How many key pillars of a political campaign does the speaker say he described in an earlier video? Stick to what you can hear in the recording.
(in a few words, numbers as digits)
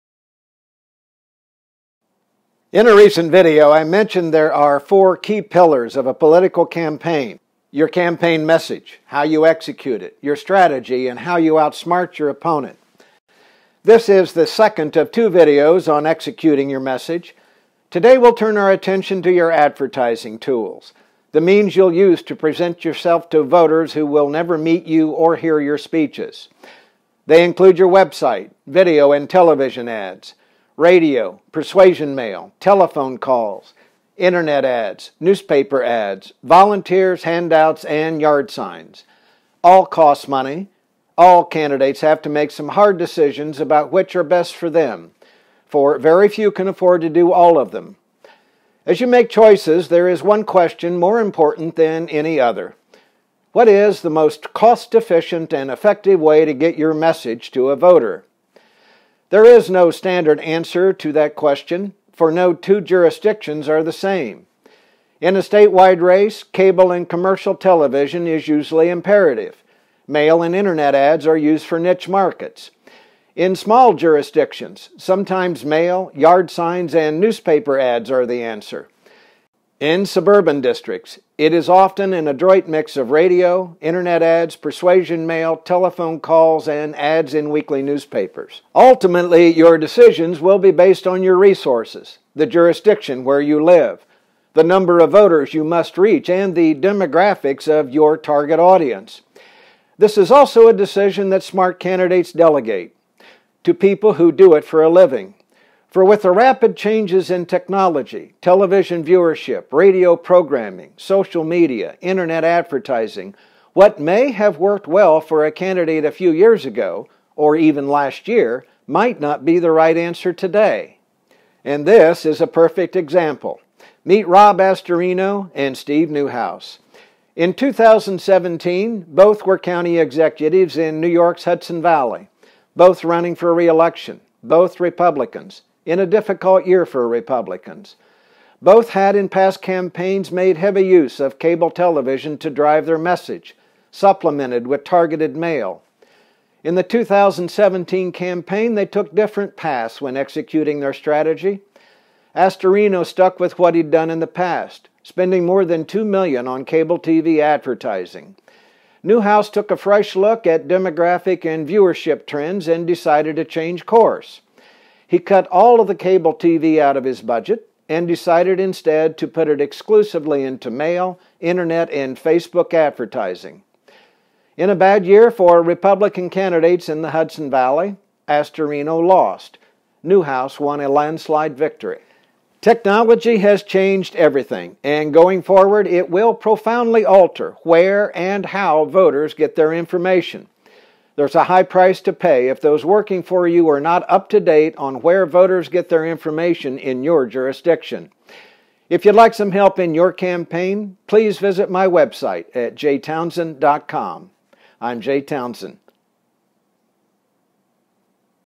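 4.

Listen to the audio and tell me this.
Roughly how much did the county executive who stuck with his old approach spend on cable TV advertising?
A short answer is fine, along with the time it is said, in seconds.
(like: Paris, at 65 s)
more than 2 million, at 155 s.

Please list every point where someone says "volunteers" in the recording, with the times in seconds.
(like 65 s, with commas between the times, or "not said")
36 s.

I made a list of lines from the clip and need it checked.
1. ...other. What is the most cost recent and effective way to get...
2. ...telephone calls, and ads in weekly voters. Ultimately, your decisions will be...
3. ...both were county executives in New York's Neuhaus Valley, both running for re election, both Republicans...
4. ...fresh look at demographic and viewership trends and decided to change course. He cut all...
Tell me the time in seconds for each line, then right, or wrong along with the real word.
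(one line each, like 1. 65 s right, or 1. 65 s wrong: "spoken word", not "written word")
1. 52 s wrong: "efficient", not "recent"
2. 85 s wrong: "newspapers", not "voters"
3. 129 s wrong: "Hudson", not "Neuhaus"
4. 159 s right.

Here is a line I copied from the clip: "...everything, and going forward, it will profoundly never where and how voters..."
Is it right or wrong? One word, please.
wrong.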